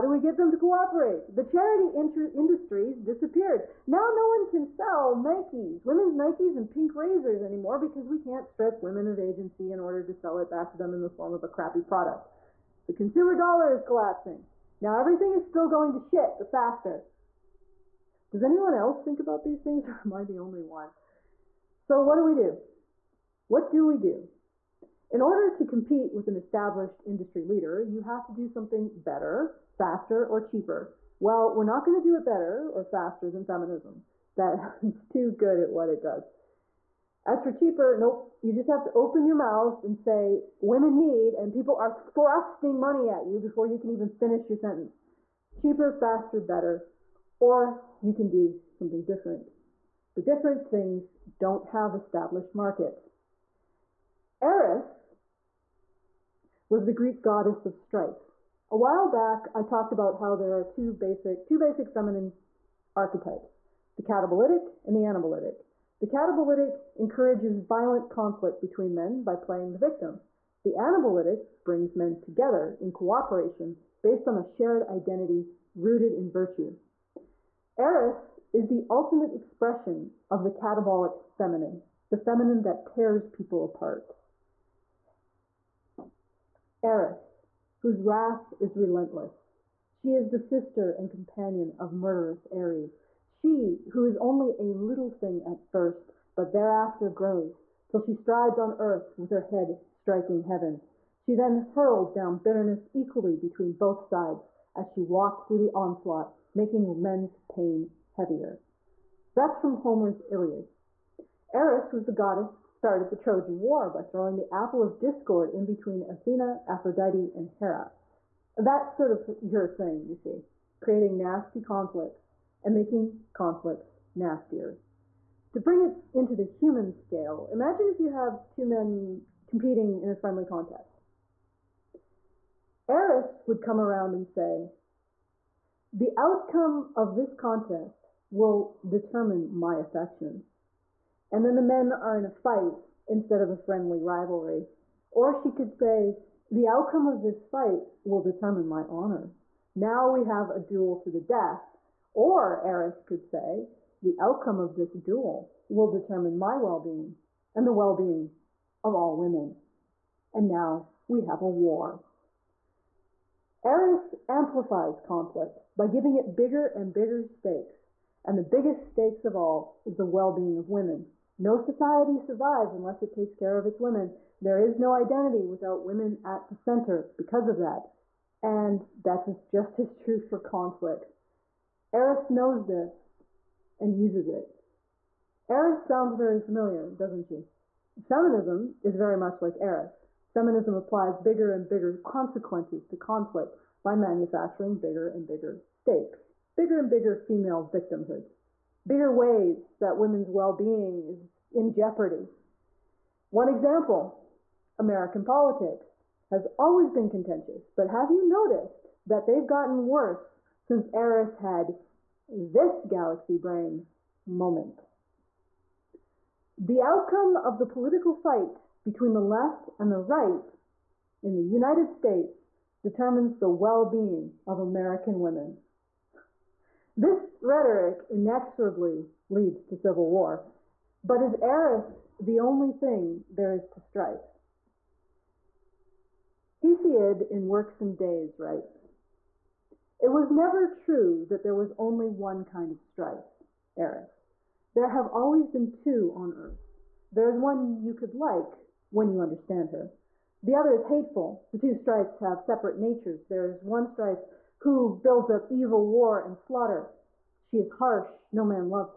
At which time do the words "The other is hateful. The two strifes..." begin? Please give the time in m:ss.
4:10.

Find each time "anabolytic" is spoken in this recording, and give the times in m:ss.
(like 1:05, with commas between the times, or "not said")
1:05, 1:10.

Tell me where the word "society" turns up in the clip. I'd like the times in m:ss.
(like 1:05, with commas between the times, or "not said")
2:51.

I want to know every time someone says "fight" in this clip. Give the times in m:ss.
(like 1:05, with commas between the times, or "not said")
2:22, 2:27, 3:38.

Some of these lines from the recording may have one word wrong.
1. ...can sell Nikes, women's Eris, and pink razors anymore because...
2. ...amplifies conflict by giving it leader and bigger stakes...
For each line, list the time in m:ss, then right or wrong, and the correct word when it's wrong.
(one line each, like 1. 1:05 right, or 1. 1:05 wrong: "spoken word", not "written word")
1. 0:04 wrong: "Nikes", not "Eris"
2. 2:44 wrong: "bigger", not "leader".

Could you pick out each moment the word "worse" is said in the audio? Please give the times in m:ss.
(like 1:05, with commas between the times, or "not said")
3:29.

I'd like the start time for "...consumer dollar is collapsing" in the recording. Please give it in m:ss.
0:12.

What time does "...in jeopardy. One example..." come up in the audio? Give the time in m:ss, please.
3:21.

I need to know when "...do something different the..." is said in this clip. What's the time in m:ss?
0:48.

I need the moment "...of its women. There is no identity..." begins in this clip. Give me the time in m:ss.
2:53.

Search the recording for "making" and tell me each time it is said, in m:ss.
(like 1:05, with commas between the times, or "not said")
1:46, 2:02.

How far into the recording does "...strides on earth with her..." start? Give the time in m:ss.
1:38.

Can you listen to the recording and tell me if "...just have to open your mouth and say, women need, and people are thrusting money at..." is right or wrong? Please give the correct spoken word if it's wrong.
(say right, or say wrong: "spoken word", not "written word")
right.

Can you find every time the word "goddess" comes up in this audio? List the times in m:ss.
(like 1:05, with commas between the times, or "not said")
0:57, 1:52.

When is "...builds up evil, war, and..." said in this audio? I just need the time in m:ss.
4:15.